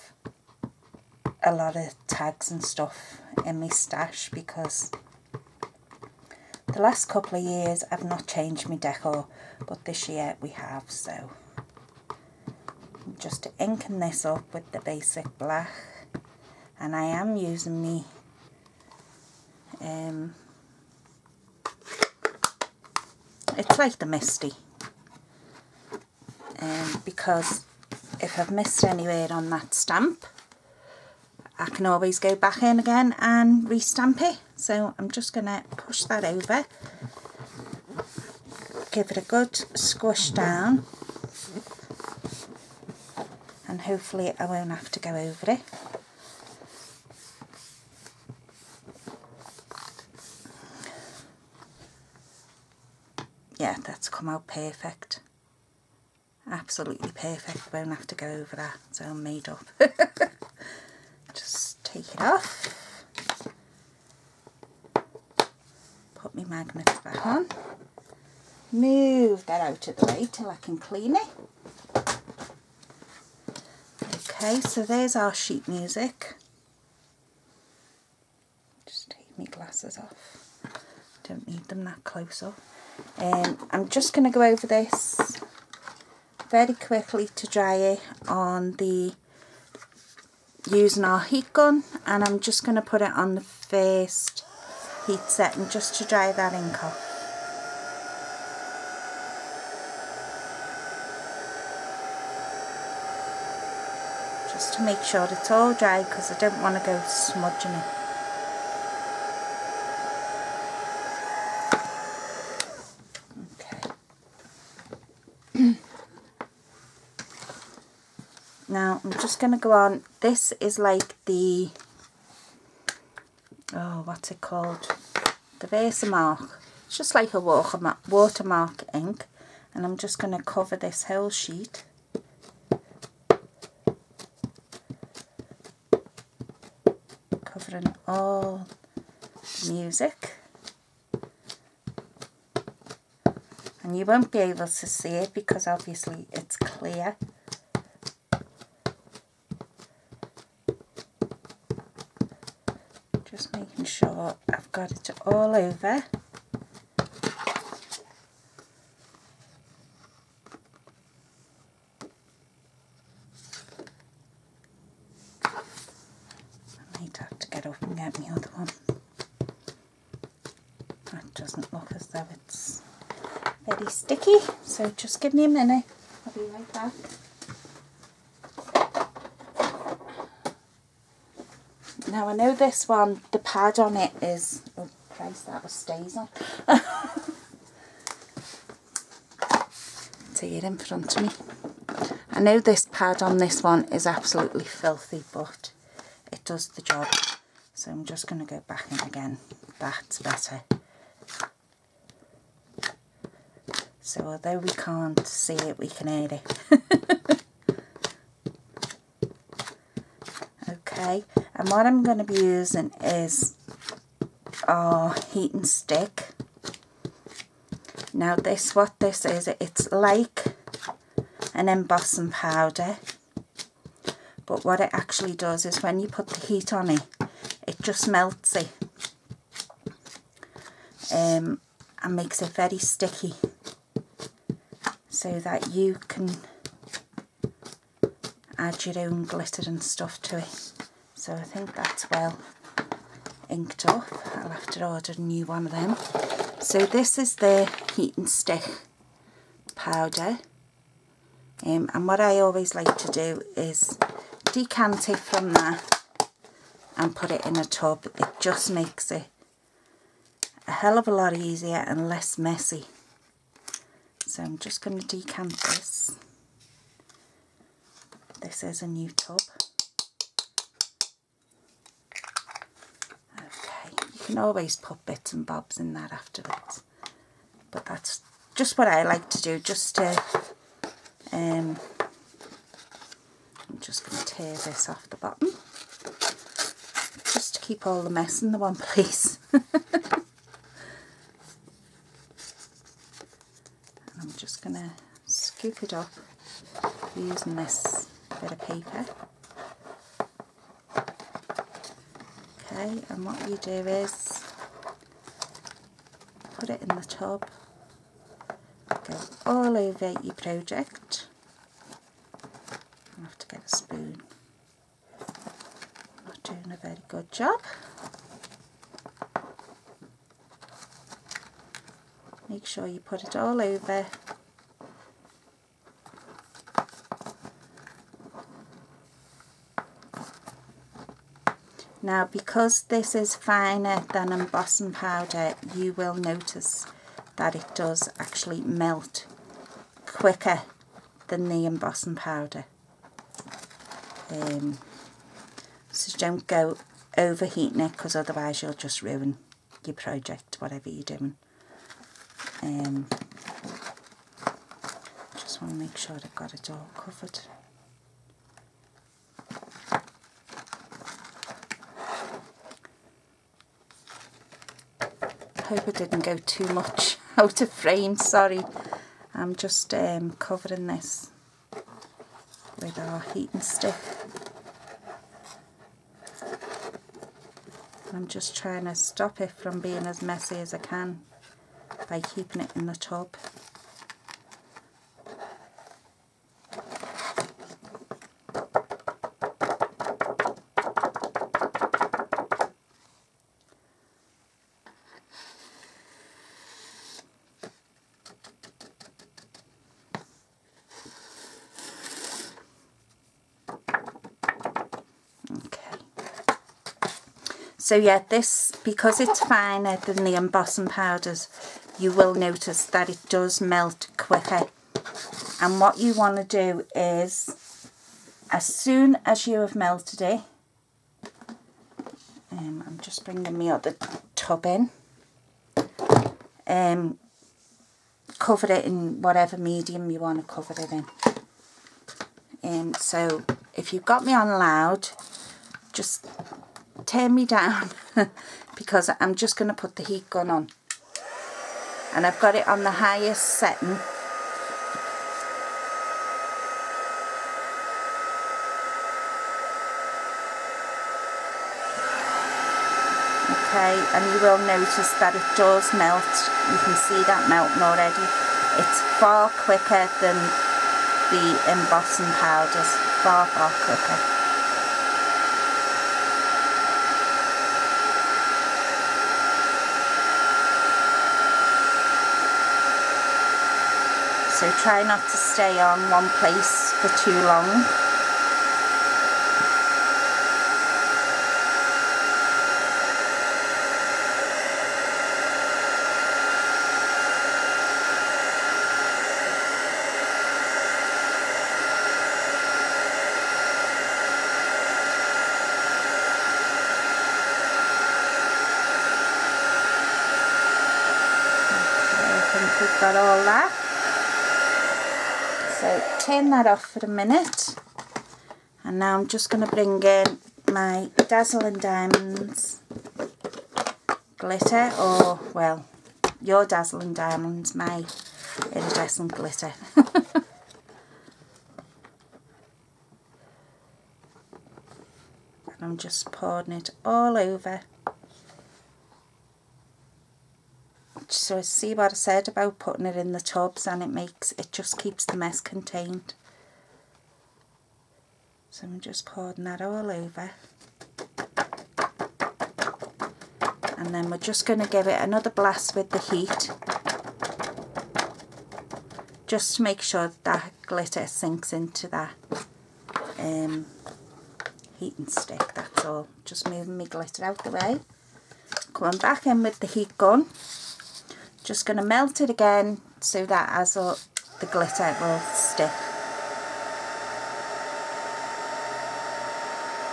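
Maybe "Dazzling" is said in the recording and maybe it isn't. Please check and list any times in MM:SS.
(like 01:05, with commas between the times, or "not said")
08:31, 08:36.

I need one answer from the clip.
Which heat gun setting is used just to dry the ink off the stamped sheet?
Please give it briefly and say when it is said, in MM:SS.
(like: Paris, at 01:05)
First heat setting, at 01:33.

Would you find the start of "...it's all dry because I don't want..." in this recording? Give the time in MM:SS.
01:45.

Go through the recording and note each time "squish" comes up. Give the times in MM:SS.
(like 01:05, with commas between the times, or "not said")
00:39.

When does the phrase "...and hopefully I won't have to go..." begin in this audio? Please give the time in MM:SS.
00:43.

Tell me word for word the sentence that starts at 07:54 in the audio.
so try not to stay on one place for too long.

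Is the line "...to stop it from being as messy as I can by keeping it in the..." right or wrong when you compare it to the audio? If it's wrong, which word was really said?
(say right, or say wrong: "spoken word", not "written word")
right.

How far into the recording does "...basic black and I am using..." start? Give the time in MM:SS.
00:14.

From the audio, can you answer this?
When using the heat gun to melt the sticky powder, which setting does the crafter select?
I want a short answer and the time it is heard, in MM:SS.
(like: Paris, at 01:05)
Highest setting, at 07:23.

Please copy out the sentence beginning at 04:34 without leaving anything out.
can always put bits and bobs in that afterwards.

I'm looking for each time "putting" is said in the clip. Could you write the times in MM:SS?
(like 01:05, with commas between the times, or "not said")
08:52.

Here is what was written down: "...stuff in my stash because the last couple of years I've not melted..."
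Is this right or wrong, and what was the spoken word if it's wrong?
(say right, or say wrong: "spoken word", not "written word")
wrong: "changed", not "melted".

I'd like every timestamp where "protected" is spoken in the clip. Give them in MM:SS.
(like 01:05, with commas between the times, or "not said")
not said.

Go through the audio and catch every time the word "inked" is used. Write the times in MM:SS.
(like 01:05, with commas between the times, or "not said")
04:03.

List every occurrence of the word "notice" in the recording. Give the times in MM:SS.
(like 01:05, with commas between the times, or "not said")
05:36, 06:52, 07:34.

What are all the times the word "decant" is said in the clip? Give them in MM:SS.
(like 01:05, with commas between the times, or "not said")
04:14, 04:25.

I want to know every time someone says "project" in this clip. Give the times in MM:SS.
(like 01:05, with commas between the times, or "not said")
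05:10, 05:49.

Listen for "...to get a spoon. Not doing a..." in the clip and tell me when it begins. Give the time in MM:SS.
05:13.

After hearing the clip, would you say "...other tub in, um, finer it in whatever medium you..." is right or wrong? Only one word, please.
wrong.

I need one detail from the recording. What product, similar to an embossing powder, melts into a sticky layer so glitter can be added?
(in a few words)
Heat and stick powder.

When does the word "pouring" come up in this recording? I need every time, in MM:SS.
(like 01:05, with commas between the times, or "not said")
08:46, 08:59.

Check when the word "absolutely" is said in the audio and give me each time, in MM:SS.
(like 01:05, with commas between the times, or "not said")
00:56, 03:14.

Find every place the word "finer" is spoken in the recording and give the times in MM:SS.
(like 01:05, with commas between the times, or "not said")
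05:33, 06:49.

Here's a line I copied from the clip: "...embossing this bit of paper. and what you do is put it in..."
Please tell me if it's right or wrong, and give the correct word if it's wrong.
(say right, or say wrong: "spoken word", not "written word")
wrong: "using", not "embossing".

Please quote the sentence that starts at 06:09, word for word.
I'm just um, covering this with our heat and stick.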